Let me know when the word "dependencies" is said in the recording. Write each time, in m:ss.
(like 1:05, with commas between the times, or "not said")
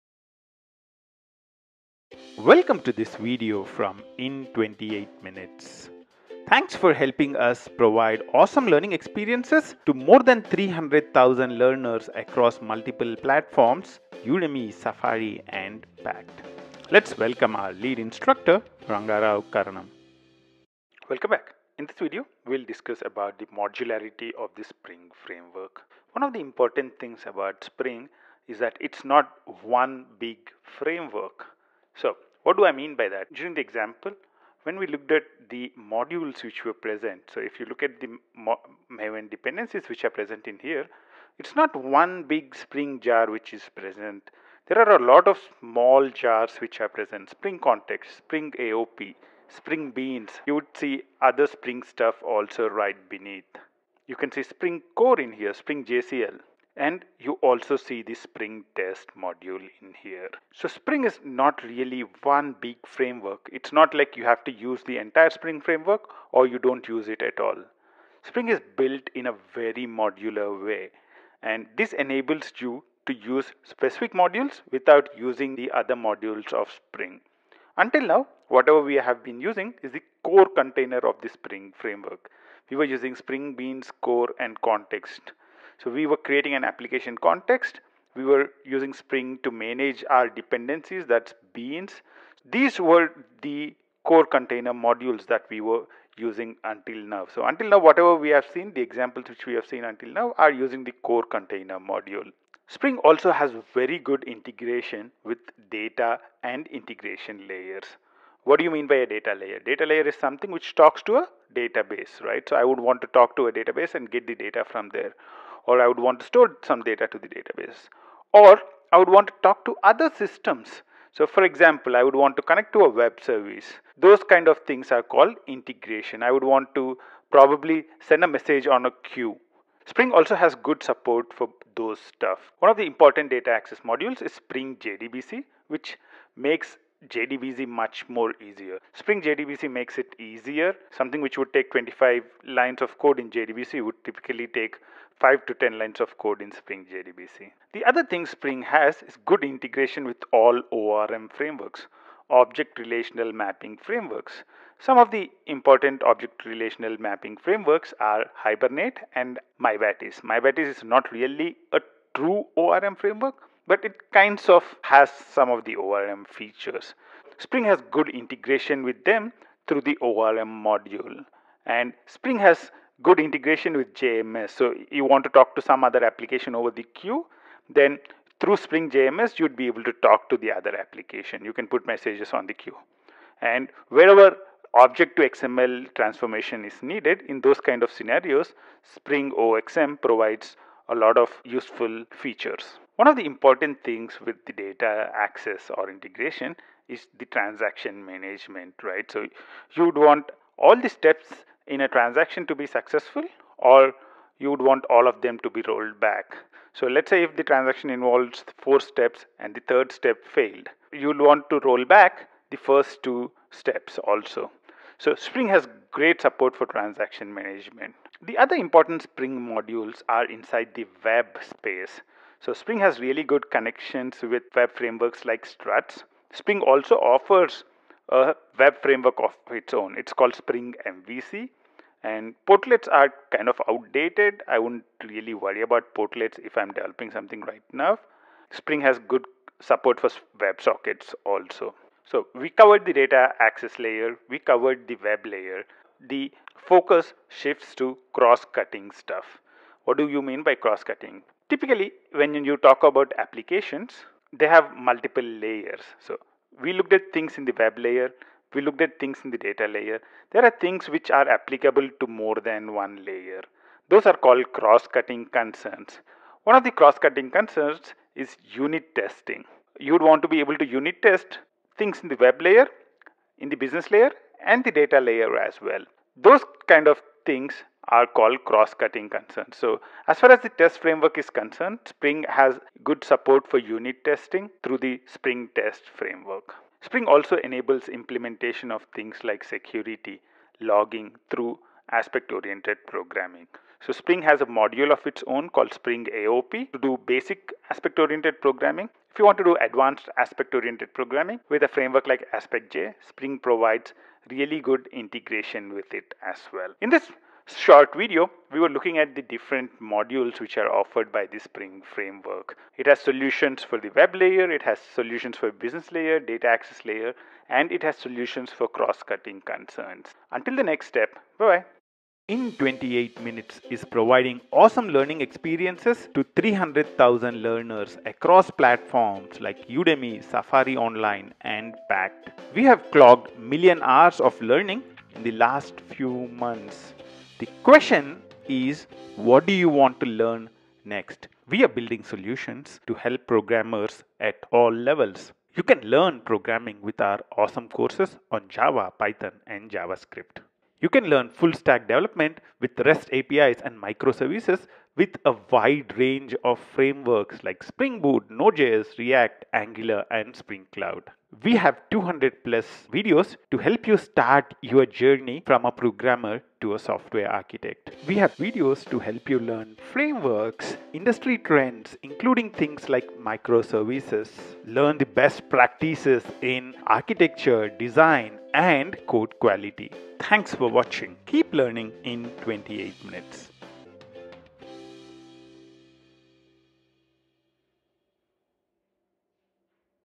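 0:39, 1:30.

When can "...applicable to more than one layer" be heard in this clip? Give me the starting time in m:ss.
4:21.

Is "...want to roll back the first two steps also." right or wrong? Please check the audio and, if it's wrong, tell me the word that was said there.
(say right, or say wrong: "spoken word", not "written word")
right.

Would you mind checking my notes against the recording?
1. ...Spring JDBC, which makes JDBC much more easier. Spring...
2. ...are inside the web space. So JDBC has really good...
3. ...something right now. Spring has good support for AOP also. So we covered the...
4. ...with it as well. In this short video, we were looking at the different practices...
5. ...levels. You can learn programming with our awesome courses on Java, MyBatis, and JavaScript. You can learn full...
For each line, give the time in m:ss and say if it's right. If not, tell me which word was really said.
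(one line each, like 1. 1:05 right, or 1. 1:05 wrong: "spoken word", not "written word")
1. 2:14 right
2. 3:40 wrong: "Spring", not "JDBC"
3. 3:57 wrong: "WebSockets", not "AOP"
4. 5:05 wrong: "modules", not "practices"
5. 5:44 wrong: "Python", not "MyBatis".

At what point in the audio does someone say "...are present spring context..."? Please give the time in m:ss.
0:46.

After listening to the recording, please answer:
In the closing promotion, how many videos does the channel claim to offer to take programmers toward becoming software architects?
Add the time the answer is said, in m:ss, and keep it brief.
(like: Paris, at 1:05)
200 plus, at 6:01.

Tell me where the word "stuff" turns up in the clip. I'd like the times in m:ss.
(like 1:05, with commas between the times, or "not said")
0:51, 2:11, 4:08.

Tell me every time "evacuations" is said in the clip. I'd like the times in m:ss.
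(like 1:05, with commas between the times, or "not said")
not said.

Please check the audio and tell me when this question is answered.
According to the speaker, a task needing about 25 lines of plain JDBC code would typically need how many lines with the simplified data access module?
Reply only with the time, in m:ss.
2:25.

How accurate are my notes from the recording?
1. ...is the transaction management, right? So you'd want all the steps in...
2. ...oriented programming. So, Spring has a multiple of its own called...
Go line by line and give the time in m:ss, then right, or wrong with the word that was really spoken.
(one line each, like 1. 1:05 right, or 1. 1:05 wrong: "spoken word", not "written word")
1. 3:16 right
2. 4:52 wrong: "module", not "multiple".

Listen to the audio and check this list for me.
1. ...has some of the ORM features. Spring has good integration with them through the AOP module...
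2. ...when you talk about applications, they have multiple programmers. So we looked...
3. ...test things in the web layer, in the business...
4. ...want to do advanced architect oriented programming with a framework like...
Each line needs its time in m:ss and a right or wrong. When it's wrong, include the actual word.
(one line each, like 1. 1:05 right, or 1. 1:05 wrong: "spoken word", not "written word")
1. 2:44 wrong: "ORM", not "AOP"
2. 4:12 wrong: "layers", not "programmers"
3. 4:31 right
4. 4:59 wrong: "aspect", not "architect".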